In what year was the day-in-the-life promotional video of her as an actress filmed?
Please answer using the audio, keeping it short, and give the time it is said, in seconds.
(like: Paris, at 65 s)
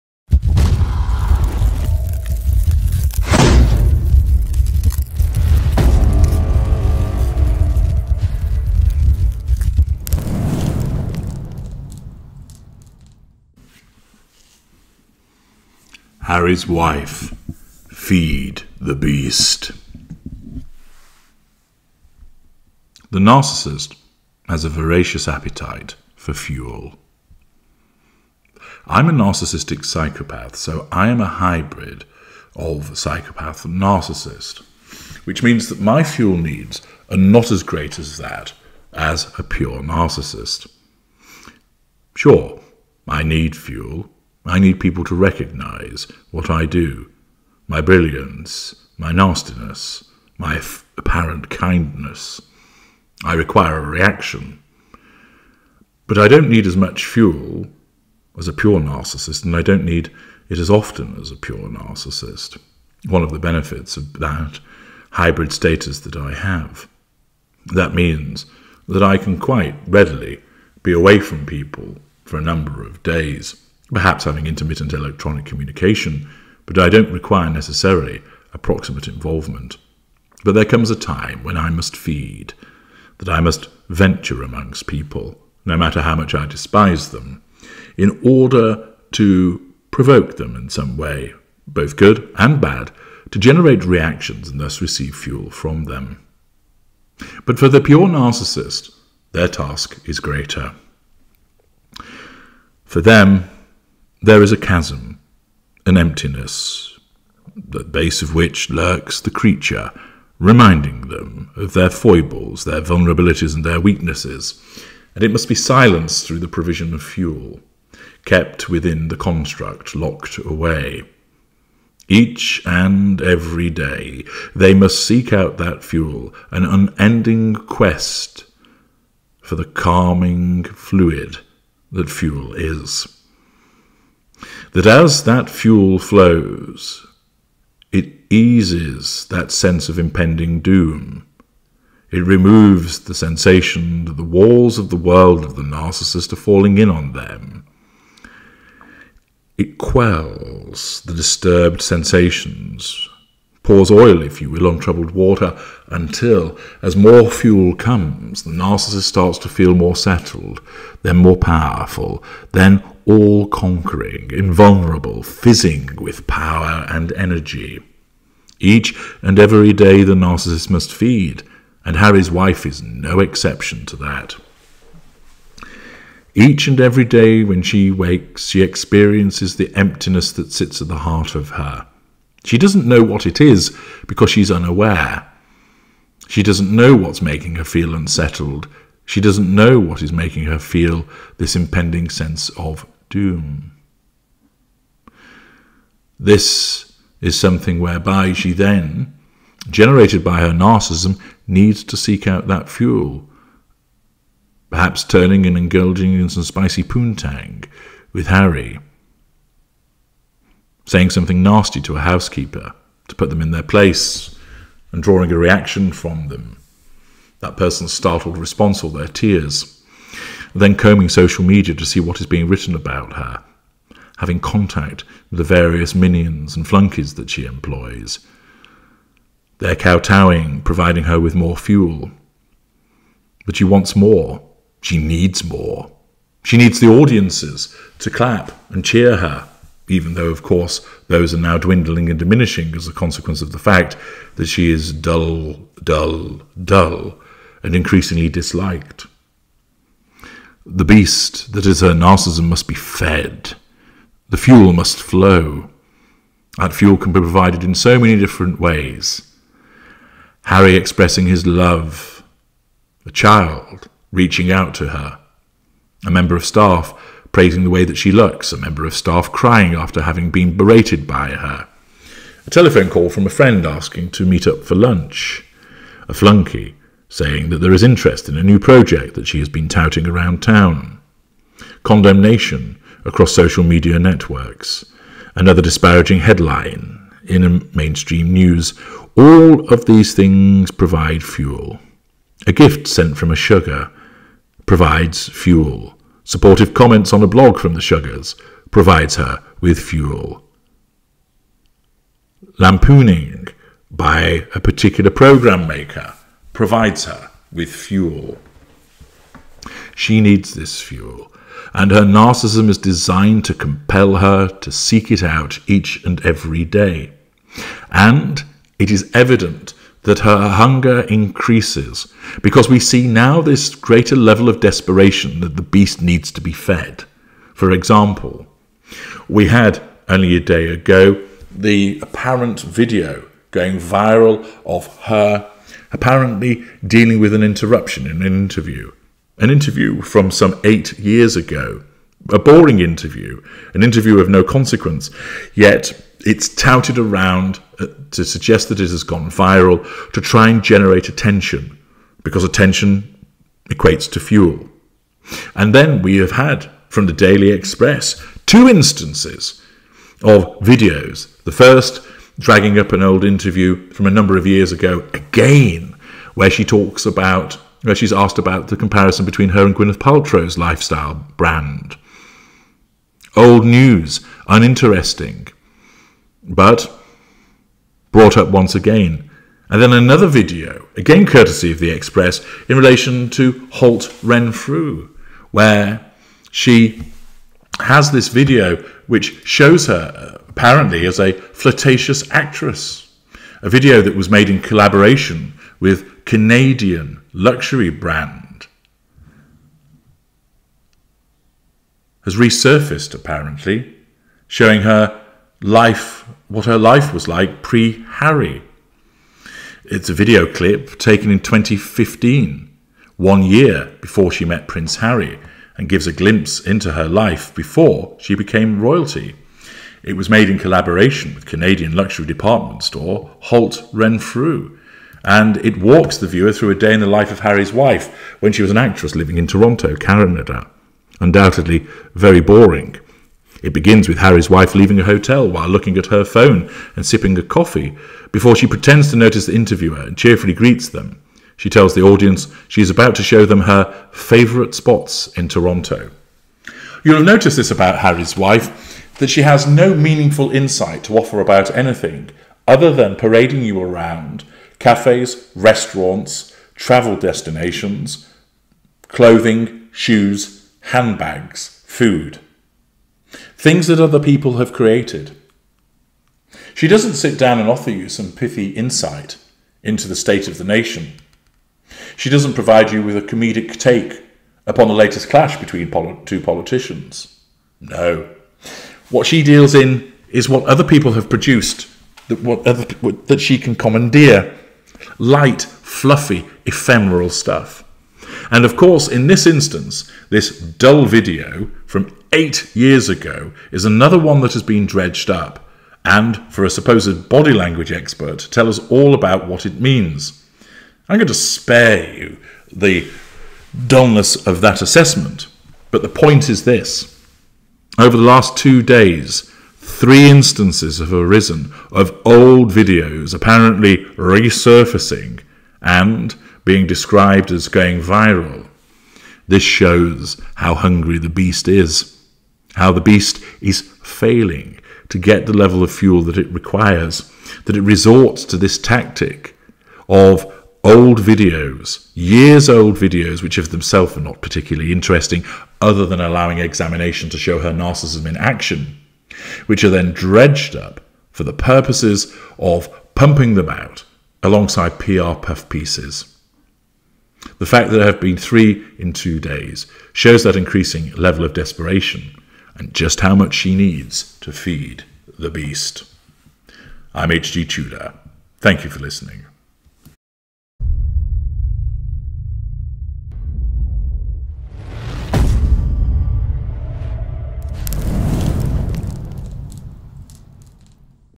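2015, at 411 s.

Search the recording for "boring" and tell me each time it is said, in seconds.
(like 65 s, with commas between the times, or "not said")
342 s, 432 s.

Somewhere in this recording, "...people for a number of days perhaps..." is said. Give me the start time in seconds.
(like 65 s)
71 s.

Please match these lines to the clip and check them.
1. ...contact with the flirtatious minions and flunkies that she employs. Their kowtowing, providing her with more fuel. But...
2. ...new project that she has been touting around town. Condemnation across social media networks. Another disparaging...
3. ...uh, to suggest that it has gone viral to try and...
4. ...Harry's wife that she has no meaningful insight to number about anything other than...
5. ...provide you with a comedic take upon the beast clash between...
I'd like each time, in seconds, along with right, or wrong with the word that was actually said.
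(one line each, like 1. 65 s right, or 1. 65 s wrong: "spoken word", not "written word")
1. 224 s wrong: "various", not "flirtatious"
2. 278 s right
3. 347 s right
4. 447 s wrong: "offer", not "number"
5. 472 s wrong: "latest", not "beast".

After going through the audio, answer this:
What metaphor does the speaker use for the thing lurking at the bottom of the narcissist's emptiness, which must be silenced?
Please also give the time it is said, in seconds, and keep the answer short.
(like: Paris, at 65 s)
the creature, at 109 s.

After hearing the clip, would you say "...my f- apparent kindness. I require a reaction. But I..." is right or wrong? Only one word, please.
right.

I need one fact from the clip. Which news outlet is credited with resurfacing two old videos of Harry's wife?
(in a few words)
Daily Express.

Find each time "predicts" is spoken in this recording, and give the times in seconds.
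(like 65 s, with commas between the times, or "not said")
not said.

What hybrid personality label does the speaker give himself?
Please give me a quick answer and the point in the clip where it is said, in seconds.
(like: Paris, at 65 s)
narcissistic psychopath, at 29 s.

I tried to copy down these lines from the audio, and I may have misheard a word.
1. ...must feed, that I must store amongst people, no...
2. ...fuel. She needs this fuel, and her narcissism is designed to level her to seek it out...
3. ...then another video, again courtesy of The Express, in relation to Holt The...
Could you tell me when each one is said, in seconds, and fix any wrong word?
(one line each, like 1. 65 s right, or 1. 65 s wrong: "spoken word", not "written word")
1. 81 s wrong: "venture", not "store"
2. 307 s wrong: "compel", not "level"
3. 379 s wrong: "Renfrew", not "The".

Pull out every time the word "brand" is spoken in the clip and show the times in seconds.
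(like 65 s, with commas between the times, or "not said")
371 s, 397 s.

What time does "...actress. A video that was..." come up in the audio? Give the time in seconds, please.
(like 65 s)
392 s.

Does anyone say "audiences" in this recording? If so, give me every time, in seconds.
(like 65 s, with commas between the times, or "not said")
236 s, 442 s.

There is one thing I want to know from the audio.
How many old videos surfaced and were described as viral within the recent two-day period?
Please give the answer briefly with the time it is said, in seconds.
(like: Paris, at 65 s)
3, at 509 s.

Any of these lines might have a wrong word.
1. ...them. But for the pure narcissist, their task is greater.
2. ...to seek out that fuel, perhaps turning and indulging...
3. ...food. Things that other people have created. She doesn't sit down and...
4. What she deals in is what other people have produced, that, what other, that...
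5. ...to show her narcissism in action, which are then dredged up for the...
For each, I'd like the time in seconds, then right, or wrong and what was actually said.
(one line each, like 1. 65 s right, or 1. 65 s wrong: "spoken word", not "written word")
1. 95 s right
2. 201 s right
3. 461 s right
4. 479 s right
5. 537 s right.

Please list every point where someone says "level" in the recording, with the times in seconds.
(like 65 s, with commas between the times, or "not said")
324 s, 525 s, 551 s.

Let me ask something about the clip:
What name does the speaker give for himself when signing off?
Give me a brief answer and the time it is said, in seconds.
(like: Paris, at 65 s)
H.G. Tudor, at 557 s.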